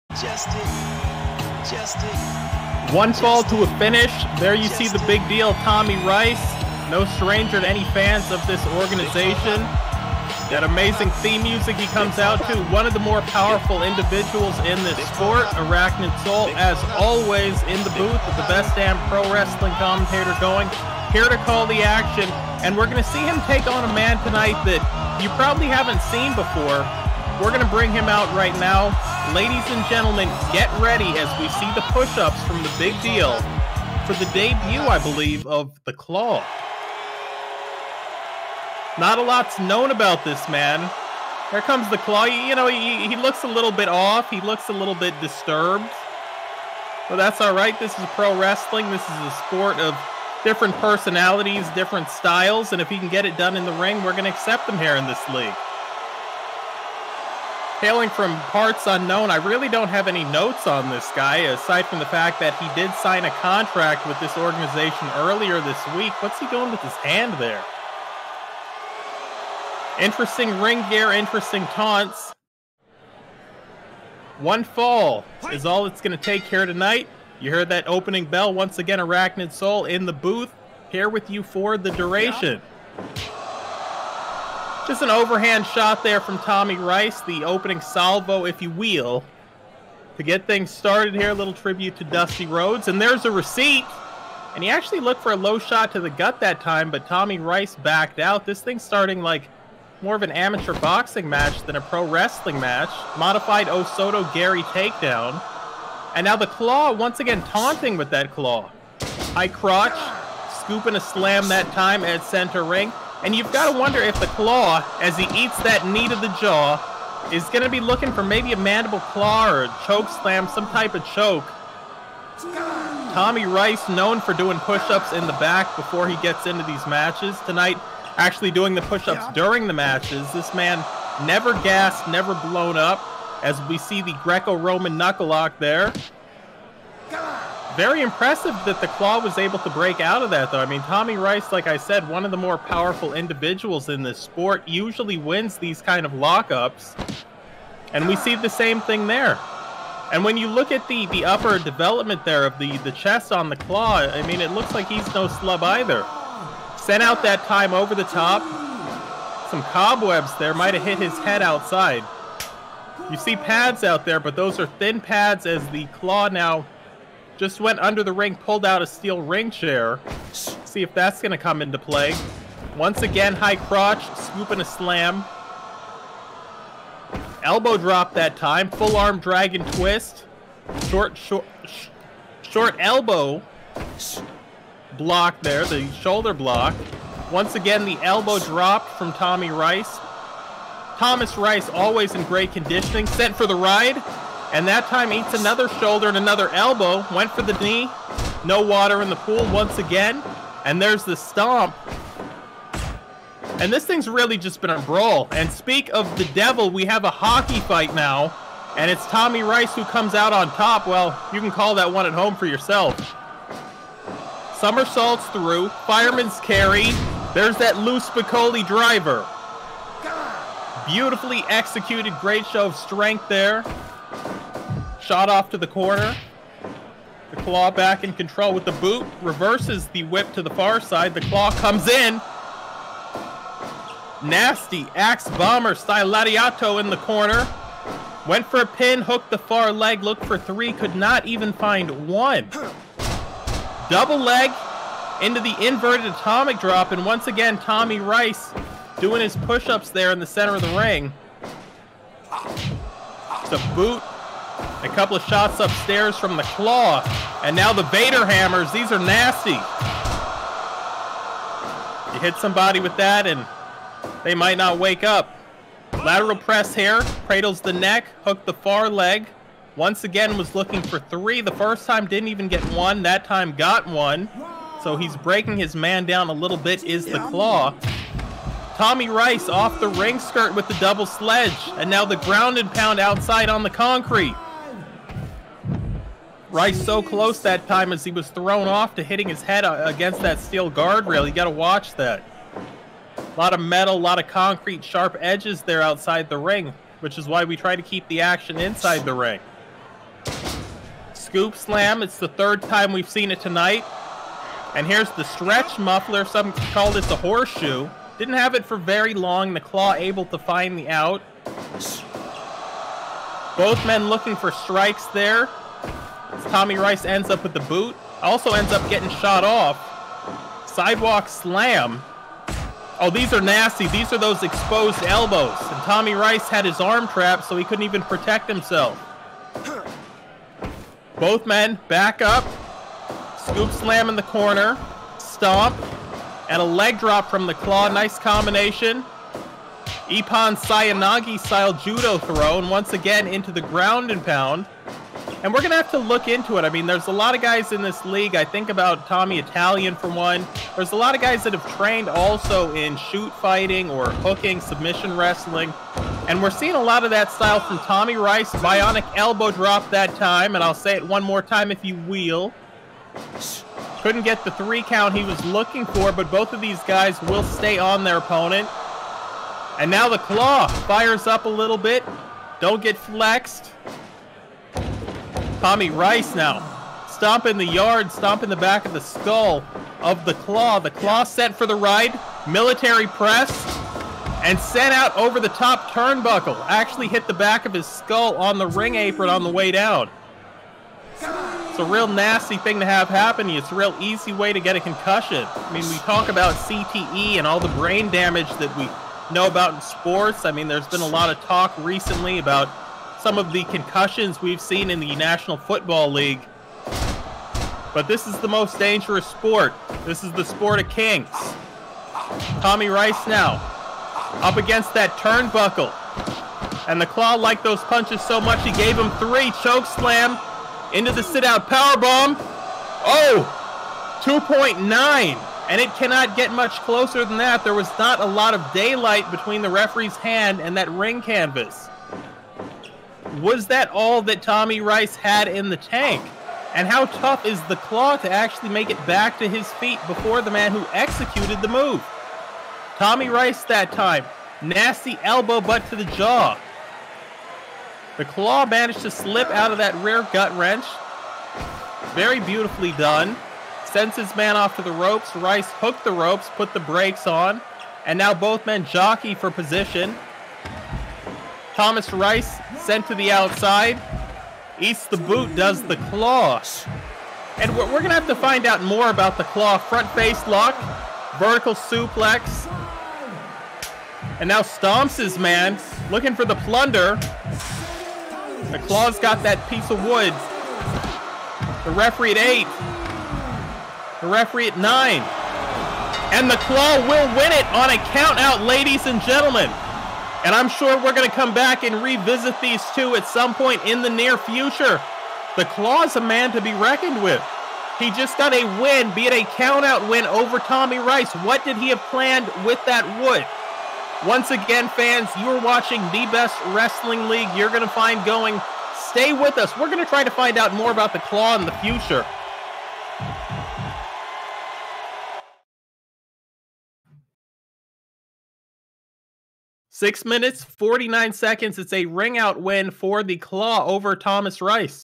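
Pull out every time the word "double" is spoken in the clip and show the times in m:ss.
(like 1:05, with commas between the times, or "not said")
4:03, 4:40.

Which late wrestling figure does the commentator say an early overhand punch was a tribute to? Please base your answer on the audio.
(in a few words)
Dusty Rhodes.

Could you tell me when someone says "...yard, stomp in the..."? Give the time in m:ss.
6:17.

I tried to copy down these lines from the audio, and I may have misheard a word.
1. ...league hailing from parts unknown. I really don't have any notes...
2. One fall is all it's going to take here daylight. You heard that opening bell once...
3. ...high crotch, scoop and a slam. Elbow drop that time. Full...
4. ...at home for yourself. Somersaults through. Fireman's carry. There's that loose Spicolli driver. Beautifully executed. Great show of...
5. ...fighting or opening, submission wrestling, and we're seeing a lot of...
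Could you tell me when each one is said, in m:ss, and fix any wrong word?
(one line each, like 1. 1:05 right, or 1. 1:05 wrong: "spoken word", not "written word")
1. 0:55 right
2. 1:14 wrong: "tonight", not "daylight"
3. 2:53 right
4. 3:32 right
5. 5:53 wrong: "hooking", not "opening".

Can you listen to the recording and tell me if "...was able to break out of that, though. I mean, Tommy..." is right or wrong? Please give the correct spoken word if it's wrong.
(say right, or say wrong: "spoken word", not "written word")
right.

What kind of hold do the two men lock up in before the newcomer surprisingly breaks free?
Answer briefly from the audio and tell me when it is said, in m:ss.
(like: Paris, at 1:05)
Greco-Roman knuckle lock, at 2:14.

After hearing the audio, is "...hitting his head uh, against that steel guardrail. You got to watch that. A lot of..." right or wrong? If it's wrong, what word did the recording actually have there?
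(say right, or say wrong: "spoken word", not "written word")
right.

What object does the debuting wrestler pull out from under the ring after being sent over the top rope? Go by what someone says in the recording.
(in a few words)
Steel ring chair.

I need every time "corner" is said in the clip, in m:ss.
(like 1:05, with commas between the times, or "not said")
3:45, 3:56, 5:34.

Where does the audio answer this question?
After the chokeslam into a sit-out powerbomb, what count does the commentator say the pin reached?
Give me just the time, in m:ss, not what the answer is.
7:04.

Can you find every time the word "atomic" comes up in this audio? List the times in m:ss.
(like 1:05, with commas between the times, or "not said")
4:06.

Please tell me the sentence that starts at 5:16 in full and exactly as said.
Tommy Rice ends up with the boot.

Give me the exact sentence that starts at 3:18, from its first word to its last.
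No water in the pool once again.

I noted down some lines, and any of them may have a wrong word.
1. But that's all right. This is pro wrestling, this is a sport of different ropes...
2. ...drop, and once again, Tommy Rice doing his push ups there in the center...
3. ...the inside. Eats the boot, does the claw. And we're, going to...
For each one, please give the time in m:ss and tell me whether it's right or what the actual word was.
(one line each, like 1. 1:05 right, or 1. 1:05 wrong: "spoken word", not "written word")
1. 0:47 wrong: "personalities", not "ropes"
2. 4:06 right
3. 7:43 wrong: "outside", not "inside".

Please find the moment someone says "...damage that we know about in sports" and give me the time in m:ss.
6:38.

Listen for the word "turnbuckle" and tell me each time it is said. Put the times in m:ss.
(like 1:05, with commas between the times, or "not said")
6:25, 6:55.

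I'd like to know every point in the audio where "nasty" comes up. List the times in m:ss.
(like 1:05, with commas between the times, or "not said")
3:54, 4:18, 5:23, 6:32, 7:24.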